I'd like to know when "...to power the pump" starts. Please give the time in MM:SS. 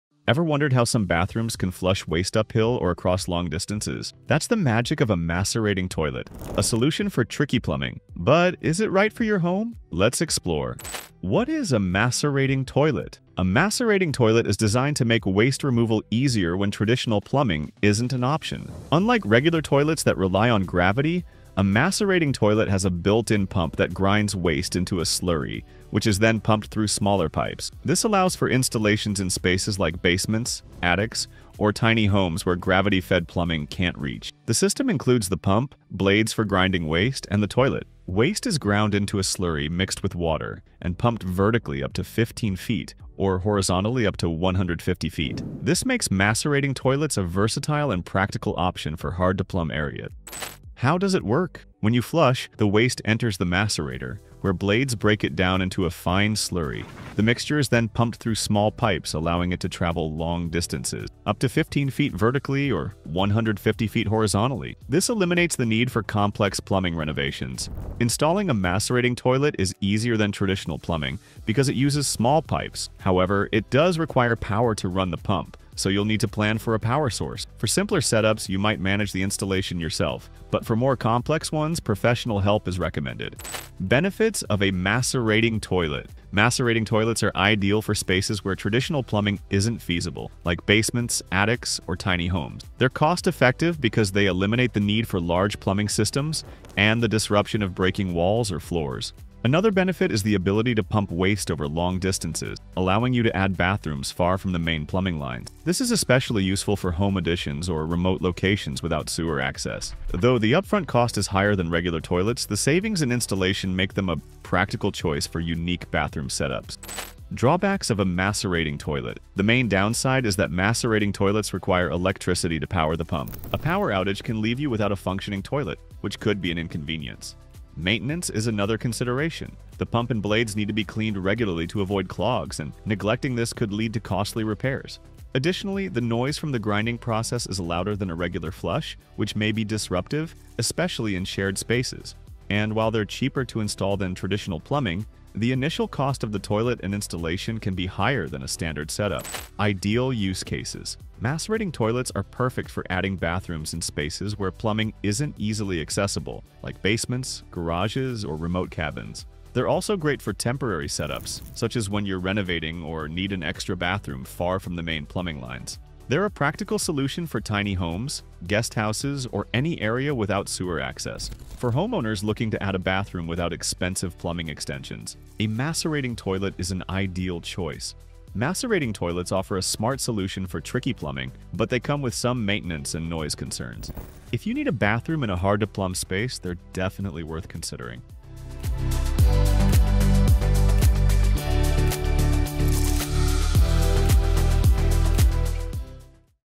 02:02.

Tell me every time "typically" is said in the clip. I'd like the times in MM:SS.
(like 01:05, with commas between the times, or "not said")
not said.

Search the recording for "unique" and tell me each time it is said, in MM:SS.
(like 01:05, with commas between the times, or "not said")
01:55.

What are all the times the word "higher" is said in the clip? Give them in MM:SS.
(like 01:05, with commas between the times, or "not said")
01:51, 02:27.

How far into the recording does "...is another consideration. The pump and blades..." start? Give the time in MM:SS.
02:08.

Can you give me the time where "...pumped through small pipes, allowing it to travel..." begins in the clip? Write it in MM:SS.
00:57.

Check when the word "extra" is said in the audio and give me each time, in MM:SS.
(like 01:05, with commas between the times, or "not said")
02:43.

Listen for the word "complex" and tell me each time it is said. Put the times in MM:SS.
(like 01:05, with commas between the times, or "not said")
01:06, 01:20.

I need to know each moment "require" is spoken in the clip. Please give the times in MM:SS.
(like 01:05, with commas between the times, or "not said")
01:13, 02:01.